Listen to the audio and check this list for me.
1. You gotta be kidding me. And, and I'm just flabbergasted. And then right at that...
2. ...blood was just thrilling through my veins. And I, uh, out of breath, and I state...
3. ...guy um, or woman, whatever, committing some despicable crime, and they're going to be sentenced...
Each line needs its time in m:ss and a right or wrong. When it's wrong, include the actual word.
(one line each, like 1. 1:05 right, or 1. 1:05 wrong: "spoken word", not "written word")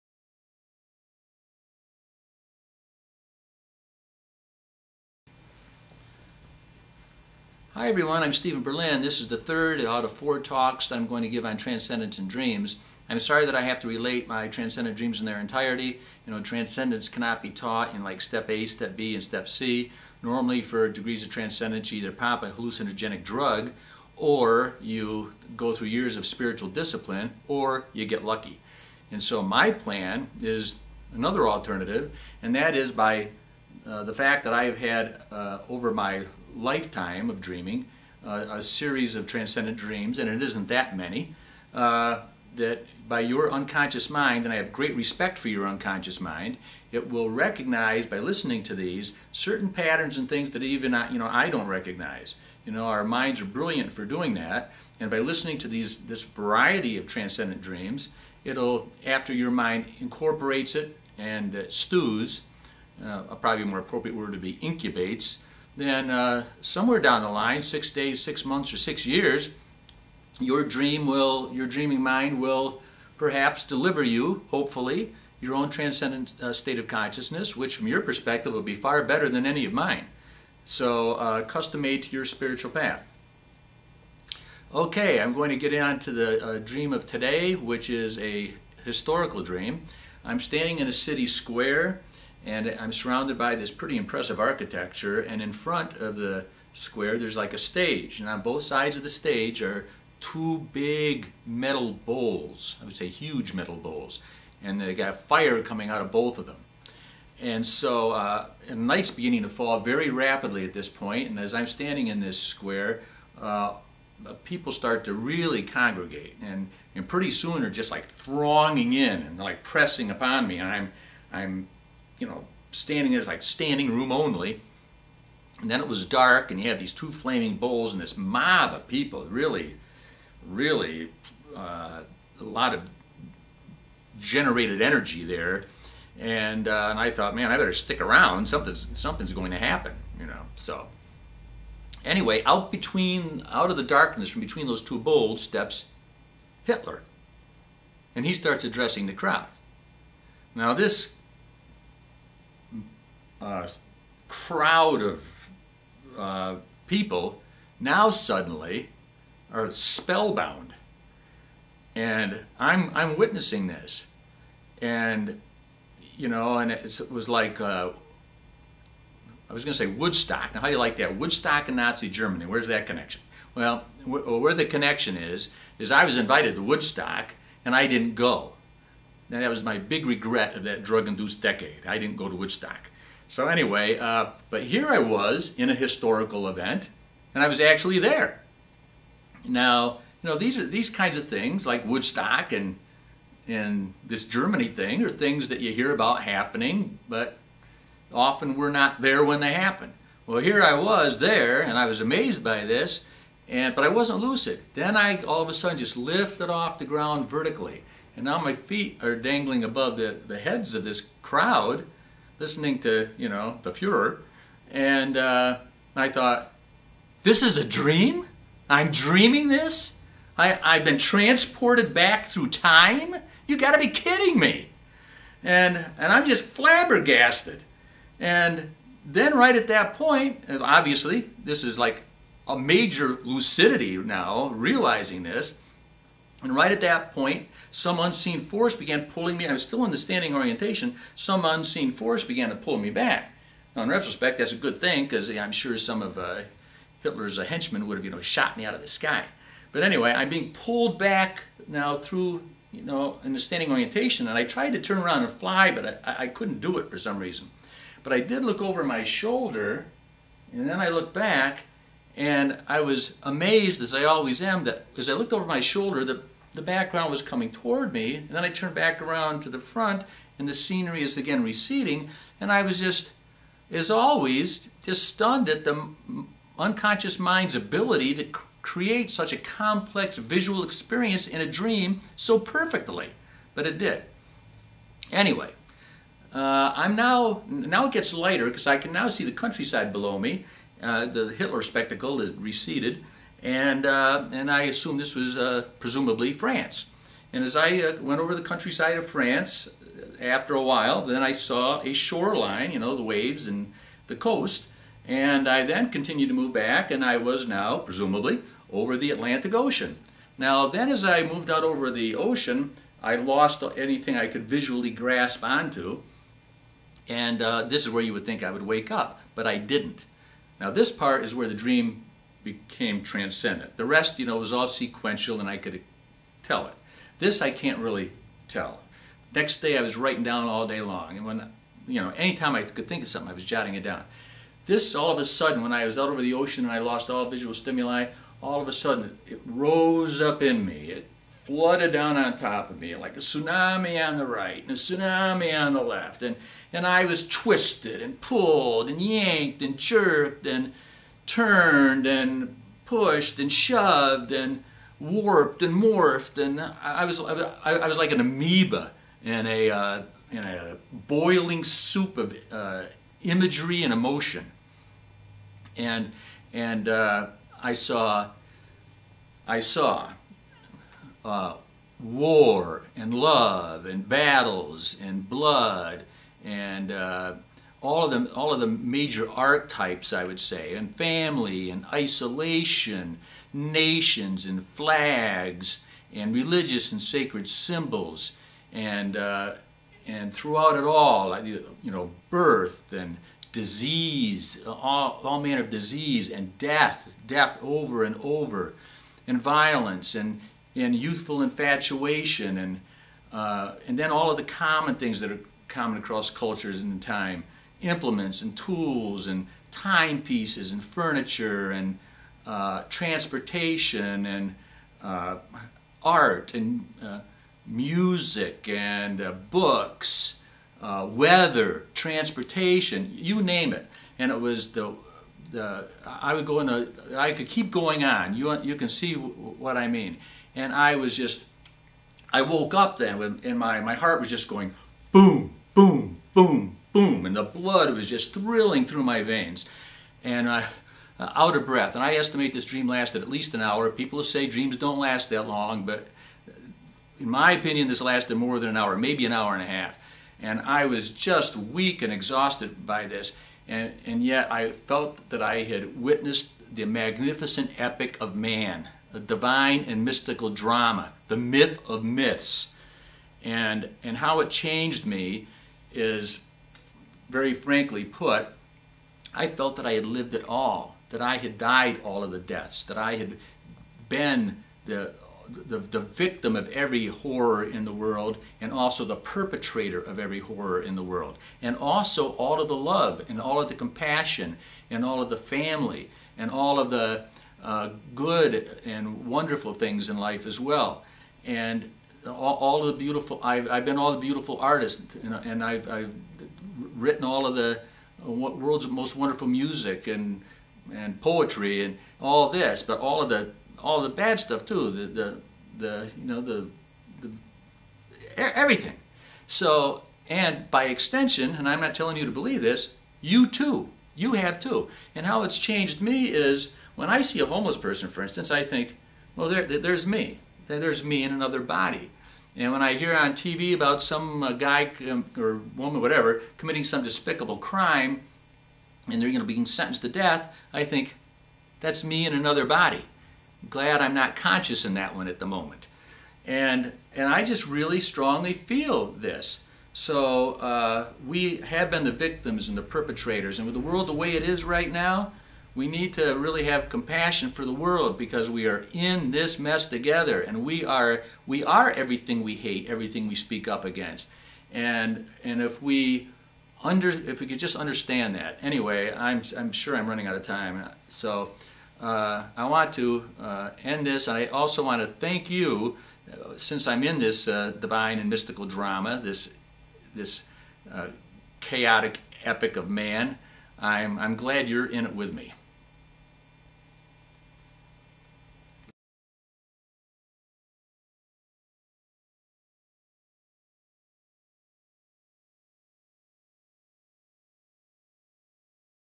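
1. 3:43 right
2. 7:17 wrong: "estimate", not "state"
3. 8:44 right.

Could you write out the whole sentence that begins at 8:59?
So uh, we have been the victims and the perpetrators.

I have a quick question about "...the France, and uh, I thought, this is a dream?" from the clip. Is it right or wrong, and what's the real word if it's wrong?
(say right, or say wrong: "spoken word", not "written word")
wrong: "Fuhrer", not "France".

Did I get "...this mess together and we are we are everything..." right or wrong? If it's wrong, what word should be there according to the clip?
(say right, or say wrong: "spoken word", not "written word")
right.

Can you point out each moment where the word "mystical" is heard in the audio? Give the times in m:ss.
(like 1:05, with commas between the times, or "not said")
7:40, 9:28.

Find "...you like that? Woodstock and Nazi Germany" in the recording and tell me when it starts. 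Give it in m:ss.
2:50.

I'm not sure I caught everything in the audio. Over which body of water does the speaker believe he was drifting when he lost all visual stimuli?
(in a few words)
Atlantic Ocean.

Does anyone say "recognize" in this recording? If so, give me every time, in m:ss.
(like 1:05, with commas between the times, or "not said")
0:47, 0:51.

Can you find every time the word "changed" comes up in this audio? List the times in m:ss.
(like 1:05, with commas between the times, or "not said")
7:44, 8:35.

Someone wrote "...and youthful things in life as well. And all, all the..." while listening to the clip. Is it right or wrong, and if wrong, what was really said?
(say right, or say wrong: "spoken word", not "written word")
wrong: "wonderful", not "youthful".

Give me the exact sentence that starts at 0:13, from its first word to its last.
I'm sorry that I have to relate my transcendent dreams in their entirety.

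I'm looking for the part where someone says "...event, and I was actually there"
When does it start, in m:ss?
3:06.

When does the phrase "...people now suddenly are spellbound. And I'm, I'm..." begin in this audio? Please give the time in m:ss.
2:36.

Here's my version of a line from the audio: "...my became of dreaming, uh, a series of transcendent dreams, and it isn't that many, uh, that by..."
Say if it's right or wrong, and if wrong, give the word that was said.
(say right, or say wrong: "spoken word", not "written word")
wrong: "lifetime", not "became".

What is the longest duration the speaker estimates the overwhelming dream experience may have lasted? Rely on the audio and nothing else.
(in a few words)
an hour and a half.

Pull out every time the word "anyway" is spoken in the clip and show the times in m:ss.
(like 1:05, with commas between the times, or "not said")
2:22, 3:03, 4:09, 4:45, 9:18.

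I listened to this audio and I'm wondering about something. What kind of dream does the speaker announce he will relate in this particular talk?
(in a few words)
historical dream.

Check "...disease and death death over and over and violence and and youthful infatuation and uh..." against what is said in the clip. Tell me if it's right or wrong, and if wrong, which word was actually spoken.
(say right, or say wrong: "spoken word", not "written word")
right.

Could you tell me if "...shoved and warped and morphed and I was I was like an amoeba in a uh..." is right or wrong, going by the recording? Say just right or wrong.
right.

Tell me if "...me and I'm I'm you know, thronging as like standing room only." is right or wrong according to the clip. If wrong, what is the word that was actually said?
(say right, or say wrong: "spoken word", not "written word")
wrong: "standing", not "thronging".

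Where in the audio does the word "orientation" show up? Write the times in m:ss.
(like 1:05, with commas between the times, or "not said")
4:00, 4:13.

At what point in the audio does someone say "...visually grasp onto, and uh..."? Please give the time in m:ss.
5:14.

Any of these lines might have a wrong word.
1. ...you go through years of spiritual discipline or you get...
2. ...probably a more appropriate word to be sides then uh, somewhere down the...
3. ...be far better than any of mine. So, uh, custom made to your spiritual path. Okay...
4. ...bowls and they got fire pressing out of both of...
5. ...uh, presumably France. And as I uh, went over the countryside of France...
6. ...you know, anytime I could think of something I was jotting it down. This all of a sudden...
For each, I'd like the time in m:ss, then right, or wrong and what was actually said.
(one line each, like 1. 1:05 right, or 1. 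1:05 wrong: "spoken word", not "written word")
1. 0:24 right
2. 1:03 wrong: "incubates", not "sides"
3. 1:18 right
4. 1:43 wrong: "coming", not "pressing"
5. 4:55 right
6. 5:31 right.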